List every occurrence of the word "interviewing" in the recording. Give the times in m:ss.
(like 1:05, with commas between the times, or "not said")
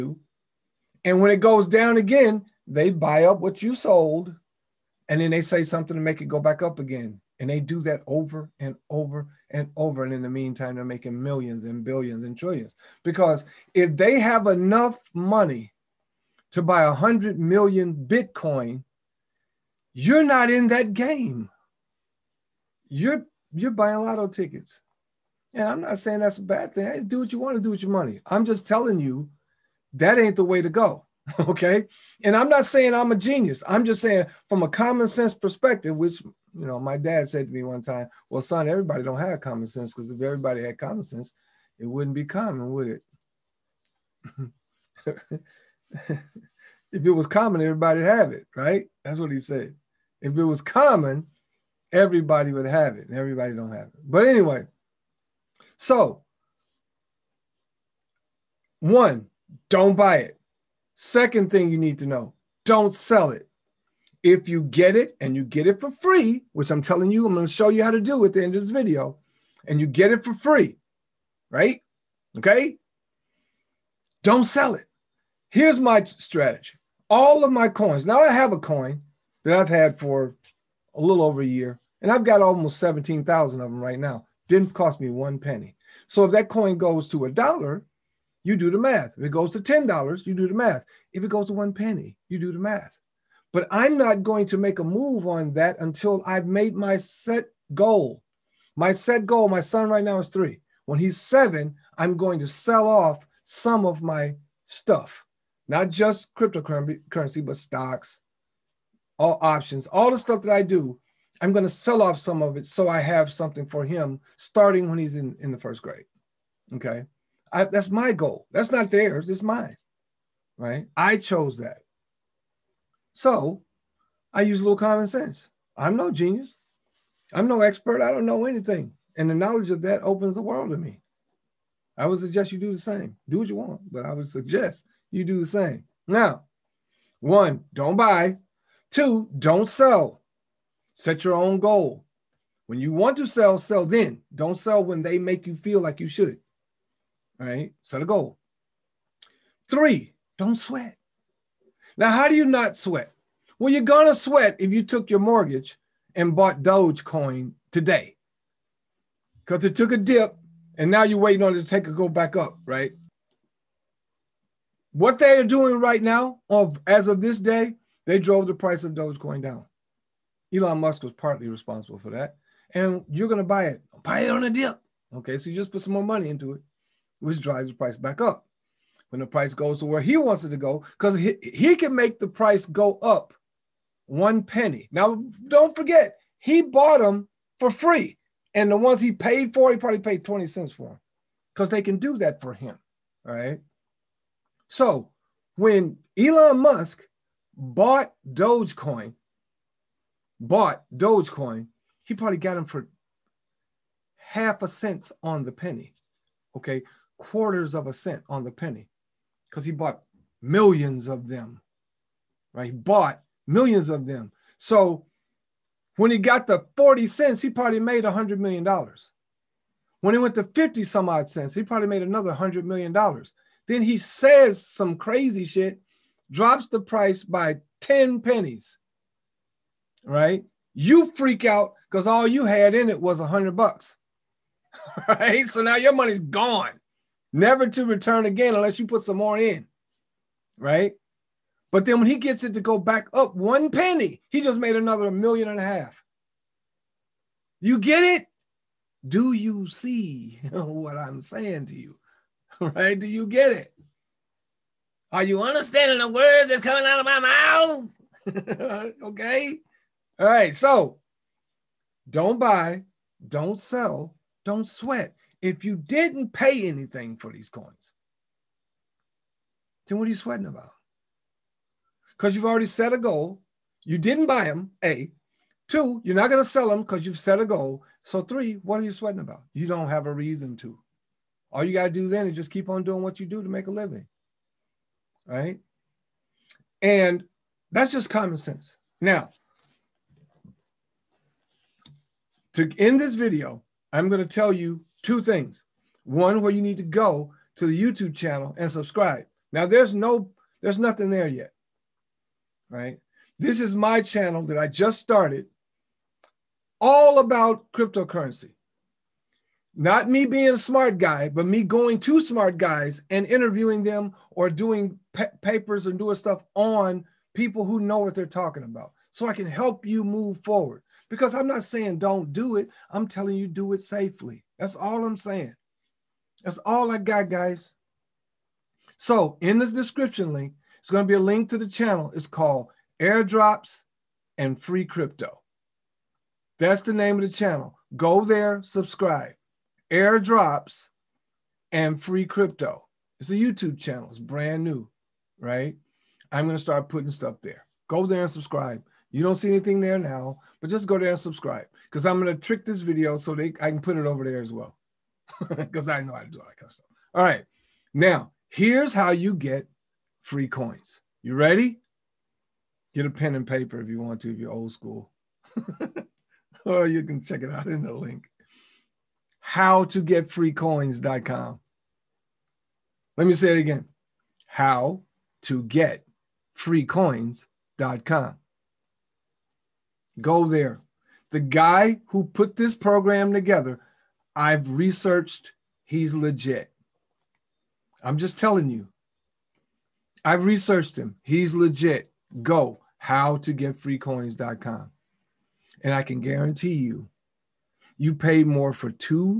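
5:13.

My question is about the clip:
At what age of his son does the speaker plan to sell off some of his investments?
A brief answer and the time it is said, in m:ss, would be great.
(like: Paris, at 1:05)
7, at 1:41.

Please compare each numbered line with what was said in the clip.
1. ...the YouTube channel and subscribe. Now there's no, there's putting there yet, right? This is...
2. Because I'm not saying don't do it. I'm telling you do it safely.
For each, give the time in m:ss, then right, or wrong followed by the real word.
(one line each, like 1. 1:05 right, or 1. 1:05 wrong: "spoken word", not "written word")
1. 4:57 wrong: "nothing", not "putting"
2. 5:21 right.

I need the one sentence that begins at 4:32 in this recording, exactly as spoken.
Because you've already set a goal.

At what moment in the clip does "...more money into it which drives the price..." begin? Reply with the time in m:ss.
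2:55.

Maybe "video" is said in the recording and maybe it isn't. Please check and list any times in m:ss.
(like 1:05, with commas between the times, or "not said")
1:08, 4:53, 5:52.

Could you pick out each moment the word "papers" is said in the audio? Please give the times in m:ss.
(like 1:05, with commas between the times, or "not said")
5:15, 6:03.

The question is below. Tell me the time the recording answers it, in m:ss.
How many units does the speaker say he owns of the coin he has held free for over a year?
1:22.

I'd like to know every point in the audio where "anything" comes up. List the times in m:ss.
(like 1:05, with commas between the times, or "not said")
2:08, 4:26, 5:49.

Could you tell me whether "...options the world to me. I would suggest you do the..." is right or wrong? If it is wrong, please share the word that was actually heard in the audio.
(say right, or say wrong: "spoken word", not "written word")
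wrong: "opens", not "options".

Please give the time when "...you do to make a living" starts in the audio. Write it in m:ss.
4:43.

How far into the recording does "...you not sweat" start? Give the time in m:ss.
2:32.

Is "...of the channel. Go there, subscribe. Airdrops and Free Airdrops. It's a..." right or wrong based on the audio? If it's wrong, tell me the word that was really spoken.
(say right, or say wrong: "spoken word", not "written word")
wrong: "Crypto", not "Airdrops".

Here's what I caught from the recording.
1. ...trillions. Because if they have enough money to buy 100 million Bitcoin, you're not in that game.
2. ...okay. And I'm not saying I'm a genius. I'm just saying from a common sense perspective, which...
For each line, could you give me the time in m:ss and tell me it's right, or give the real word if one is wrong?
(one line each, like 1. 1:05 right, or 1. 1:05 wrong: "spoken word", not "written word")
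1. 0:12 right
2. 0:31 right.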